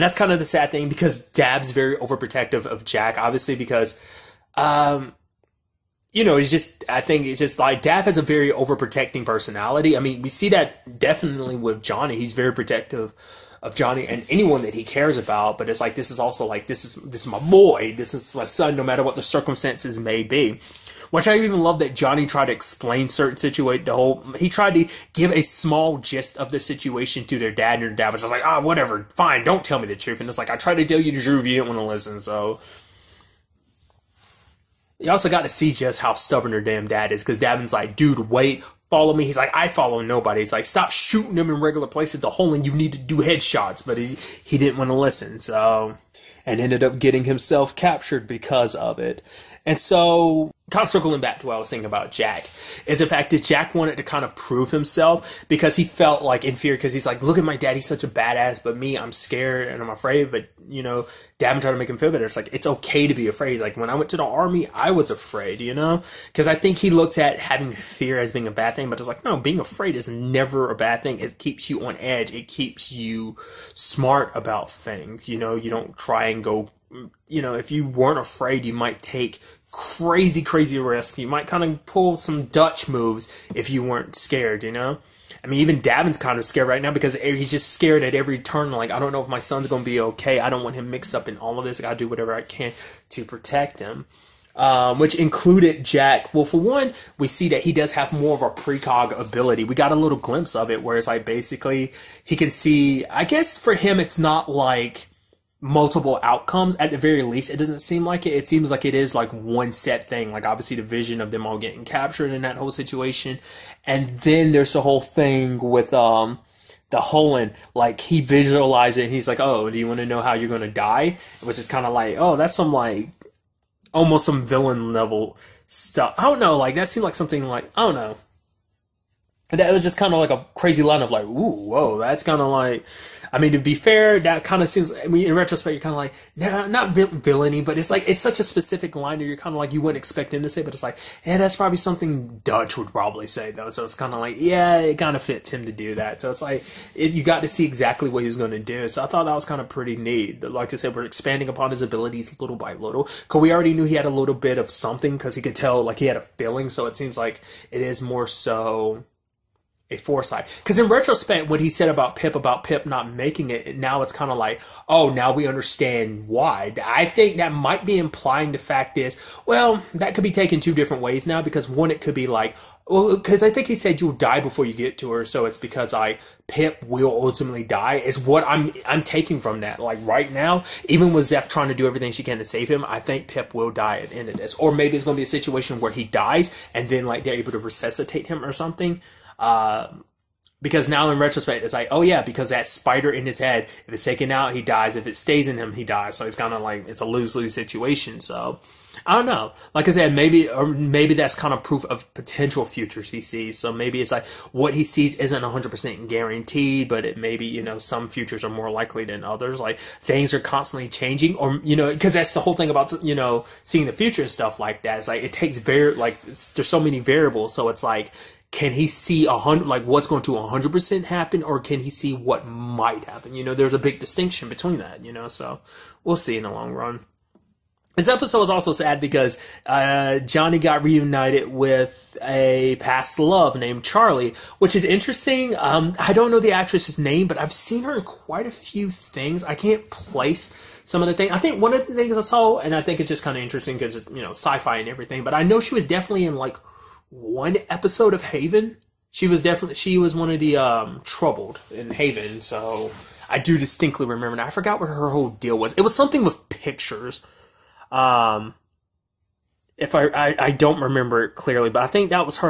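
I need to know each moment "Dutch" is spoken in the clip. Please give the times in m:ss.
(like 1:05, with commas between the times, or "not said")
1:22, 2:22.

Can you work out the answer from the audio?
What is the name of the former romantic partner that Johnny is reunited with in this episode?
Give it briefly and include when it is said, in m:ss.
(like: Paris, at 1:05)
Charlie, at 3:53.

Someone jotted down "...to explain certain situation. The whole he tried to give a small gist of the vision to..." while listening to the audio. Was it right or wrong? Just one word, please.
wrong.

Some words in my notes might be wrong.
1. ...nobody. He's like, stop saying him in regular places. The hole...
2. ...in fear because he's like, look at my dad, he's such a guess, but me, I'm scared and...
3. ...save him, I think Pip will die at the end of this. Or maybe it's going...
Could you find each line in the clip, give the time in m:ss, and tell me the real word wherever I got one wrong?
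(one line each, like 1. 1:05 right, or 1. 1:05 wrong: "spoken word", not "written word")
1. 0:40 wrong: "shooting", not "saying"
2. 0:56 wrong: "badass", not "guess"
3. 3:02 right.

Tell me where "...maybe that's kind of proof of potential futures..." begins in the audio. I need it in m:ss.
3:20.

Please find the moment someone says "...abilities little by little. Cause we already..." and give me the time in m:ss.
2:31.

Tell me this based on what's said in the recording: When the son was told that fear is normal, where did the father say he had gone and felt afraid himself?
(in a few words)
the army.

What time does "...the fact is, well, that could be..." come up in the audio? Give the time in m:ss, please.
2:48.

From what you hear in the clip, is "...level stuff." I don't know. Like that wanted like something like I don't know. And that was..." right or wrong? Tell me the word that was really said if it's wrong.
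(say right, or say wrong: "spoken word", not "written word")
wrong: "seemed", not "wanted".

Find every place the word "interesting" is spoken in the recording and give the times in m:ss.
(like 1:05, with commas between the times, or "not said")
3:54, 4:03.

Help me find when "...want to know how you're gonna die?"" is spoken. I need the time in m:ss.
1:59.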